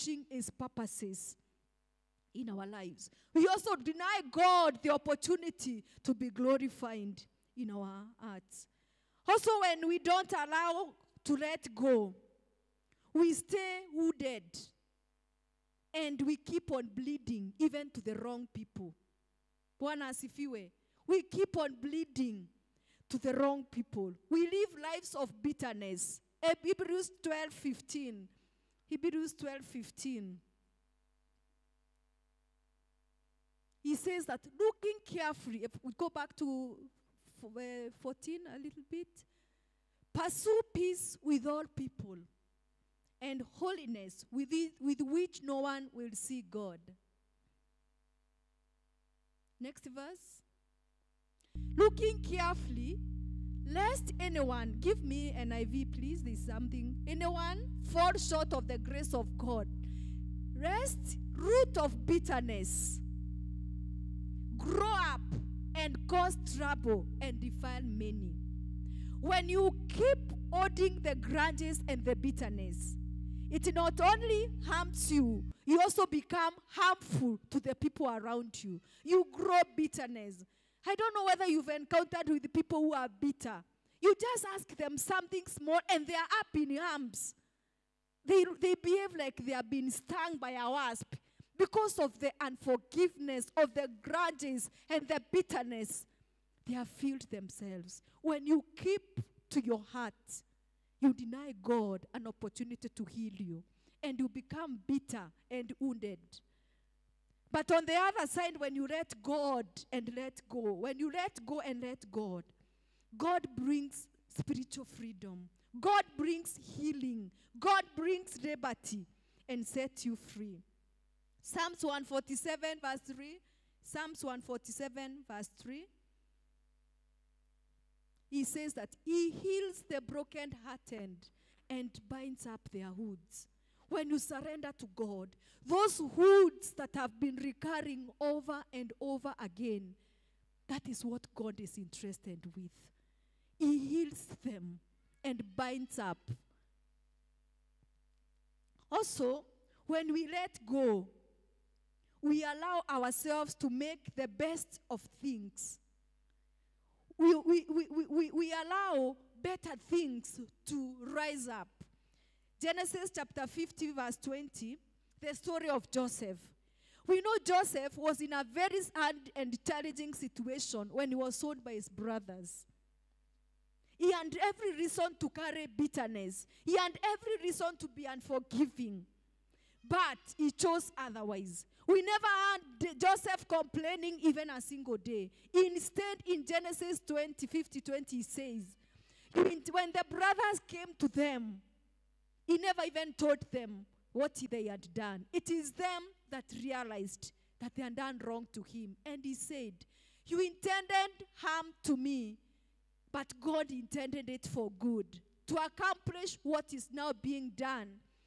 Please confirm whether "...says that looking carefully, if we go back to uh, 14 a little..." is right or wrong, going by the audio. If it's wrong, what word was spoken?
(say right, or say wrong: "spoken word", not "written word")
right.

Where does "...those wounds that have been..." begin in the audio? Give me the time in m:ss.
2:15.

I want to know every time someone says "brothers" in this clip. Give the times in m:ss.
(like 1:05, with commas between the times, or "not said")
2:51, 3:10.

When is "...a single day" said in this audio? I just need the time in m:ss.
3:04.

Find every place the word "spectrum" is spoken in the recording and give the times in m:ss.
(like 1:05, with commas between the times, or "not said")
not said.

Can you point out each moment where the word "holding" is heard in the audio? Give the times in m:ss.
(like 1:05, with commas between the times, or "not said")
1:10.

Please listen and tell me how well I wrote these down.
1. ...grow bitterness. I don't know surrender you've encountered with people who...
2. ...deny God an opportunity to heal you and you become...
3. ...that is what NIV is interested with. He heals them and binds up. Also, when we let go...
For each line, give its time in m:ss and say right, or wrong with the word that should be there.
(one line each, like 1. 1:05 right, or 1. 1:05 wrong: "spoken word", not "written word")
1. 1:19 wrong: "whether", not "surrender"
2. 1:41 right
3. 2:20 wrong: "God", not "NIV".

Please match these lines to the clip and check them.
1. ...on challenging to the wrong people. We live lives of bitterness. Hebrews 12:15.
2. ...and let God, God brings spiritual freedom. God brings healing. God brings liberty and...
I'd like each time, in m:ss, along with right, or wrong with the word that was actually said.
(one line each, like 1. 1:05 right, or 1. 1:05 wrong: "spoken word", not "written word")
1. 0:21 wrong: "bleeding", not "challenging"
2. 1:51 right.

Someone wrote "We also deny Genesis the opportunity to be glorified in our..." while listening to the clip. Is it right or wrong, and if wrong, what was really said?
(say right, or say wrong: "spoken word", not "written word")
wrong: "God", not "Genesis".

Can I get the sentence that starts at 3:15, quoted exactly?
It is them that realized that they had done wrong to him.